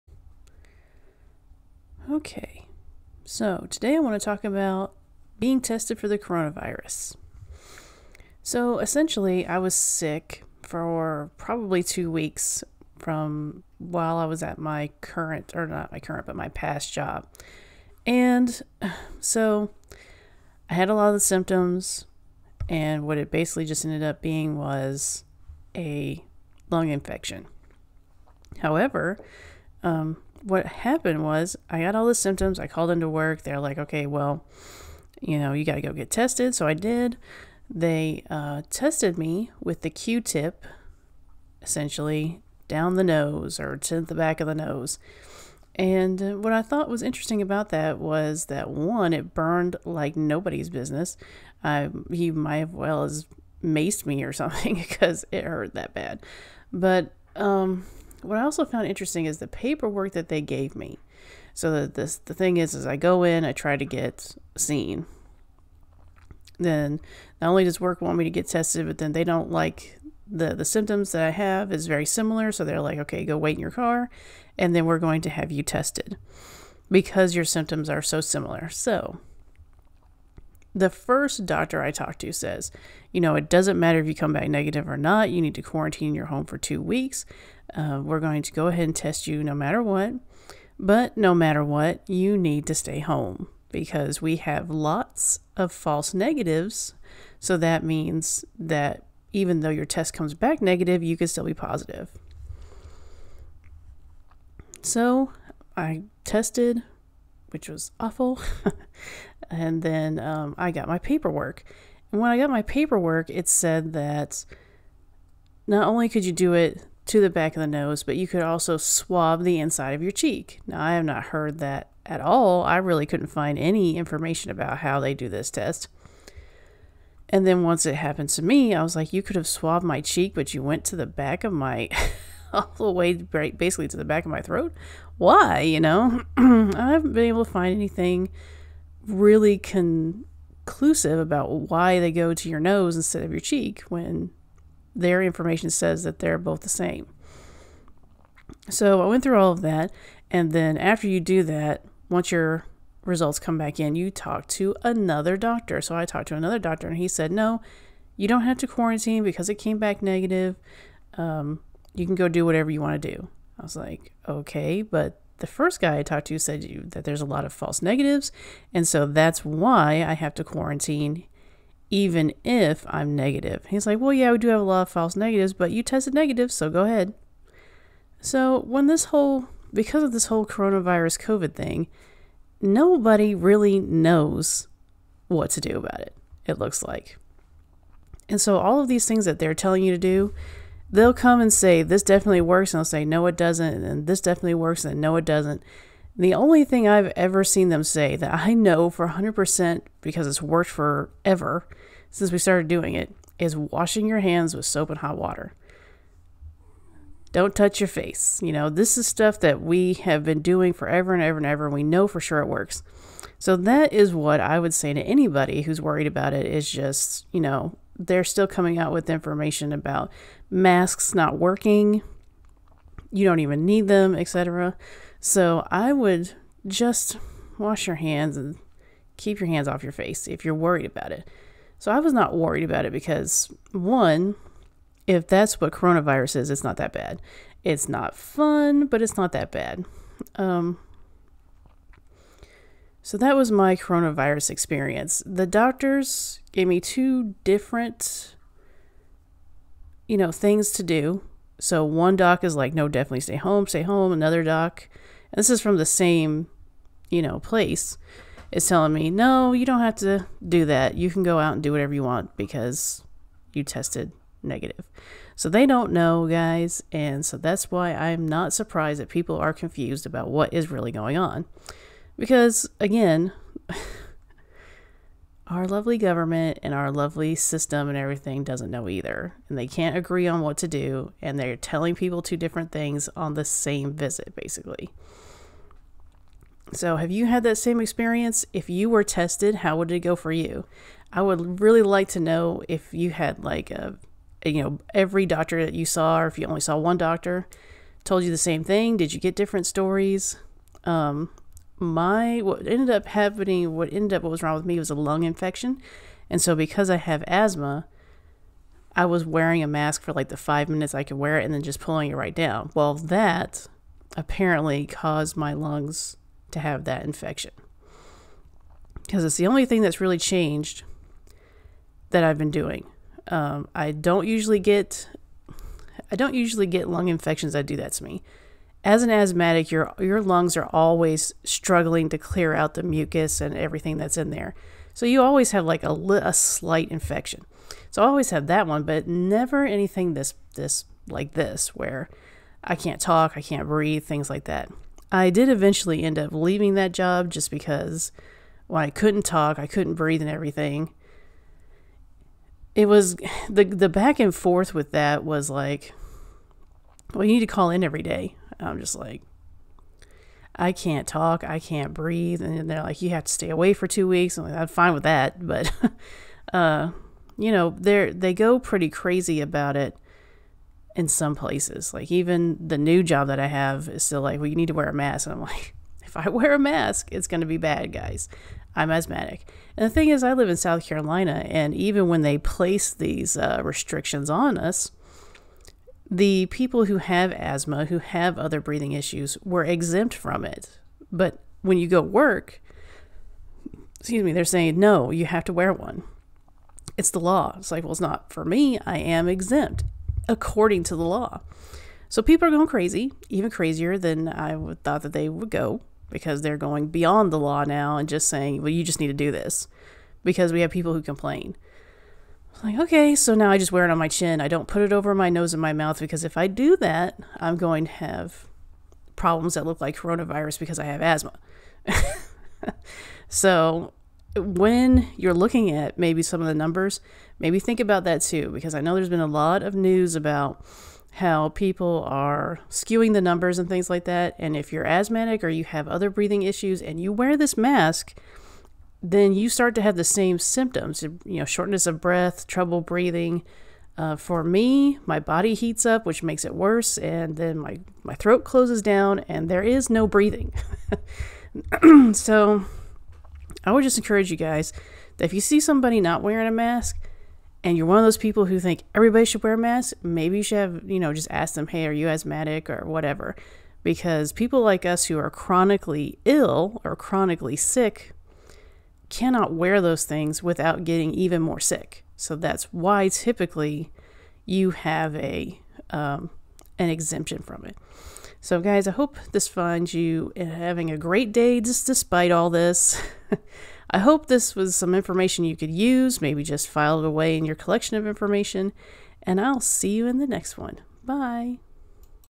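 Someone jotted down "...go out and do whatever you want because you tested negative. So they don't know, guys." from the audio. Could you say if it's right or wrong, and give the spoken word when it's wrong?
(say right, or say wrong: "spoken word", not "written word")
right.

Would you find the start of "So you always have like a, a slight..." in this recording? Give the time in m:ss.
5:34.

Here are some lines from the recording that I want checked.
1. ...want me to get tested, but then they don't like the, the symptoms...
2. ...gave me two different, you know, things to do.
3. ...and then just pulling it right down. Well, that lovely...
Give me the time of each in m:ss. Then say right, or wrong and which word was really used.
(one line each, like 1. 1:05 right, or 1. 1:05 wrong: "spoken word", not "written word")
1. 1:08 right
2. 4:06 right
3. 5:11 wrong: "apparently", not "lovely".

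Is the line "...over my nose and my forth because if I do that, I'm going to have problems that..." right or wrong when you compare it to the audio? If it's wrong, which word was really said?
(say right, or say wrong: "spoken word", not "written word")
wrong: "mouth", not "forth".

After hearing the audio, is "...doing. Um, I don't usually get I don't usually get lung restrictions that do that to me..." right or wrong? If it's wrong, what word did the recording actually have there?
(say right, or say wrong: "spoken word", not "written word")
wrong: "infections", not "restrictions".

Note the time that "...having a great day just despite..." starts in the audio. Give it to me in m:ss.
8:00.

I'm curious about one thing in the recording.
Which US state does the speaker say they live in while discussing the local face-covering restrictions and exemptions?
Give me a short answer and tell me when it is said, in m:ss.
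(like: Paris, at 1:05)
South Carolina, at 6:20.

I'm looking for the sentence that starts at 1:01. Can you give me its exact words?
So the, this, the thing is, is I go in, I try to get seen.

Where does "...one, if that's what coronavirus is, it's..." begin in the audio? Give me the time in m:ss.
3:53.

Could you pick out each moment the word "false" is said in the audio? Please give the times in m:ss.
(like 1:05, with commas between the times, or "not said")
1:35, 2:47, 2:54.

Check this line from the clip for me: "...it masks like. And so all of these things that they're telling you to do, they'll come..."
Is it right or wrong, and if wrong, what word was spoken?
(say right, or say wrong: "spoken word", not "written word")
wrong: "looks", not "masks".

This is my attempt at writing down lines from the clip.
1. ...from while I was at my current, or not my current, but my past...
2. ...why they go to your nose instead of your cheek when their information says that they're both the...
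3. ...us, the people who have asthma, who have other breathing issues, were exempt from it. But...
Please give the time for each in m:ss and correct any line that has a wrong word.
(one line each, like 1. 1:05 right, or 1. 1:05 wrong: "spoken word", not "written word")
1. 0:12 right
2. 2:21 right
3. 6:24 right.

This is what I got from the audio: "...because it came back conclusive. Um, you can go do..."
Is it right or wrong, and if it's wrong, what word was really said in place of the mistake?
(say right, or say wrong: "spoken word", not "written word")
wrong: "negative", not "conclusive".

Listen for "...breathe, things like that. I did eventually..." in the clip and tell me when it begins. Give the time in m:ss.
5:43.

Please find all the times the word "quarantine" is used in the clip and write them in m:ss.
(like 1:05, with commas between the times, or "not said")
1:25, 2:38, 2:50.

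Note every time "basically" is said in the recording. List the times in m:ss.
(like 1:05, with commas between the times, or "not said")
0:23, 2:13, 4:44.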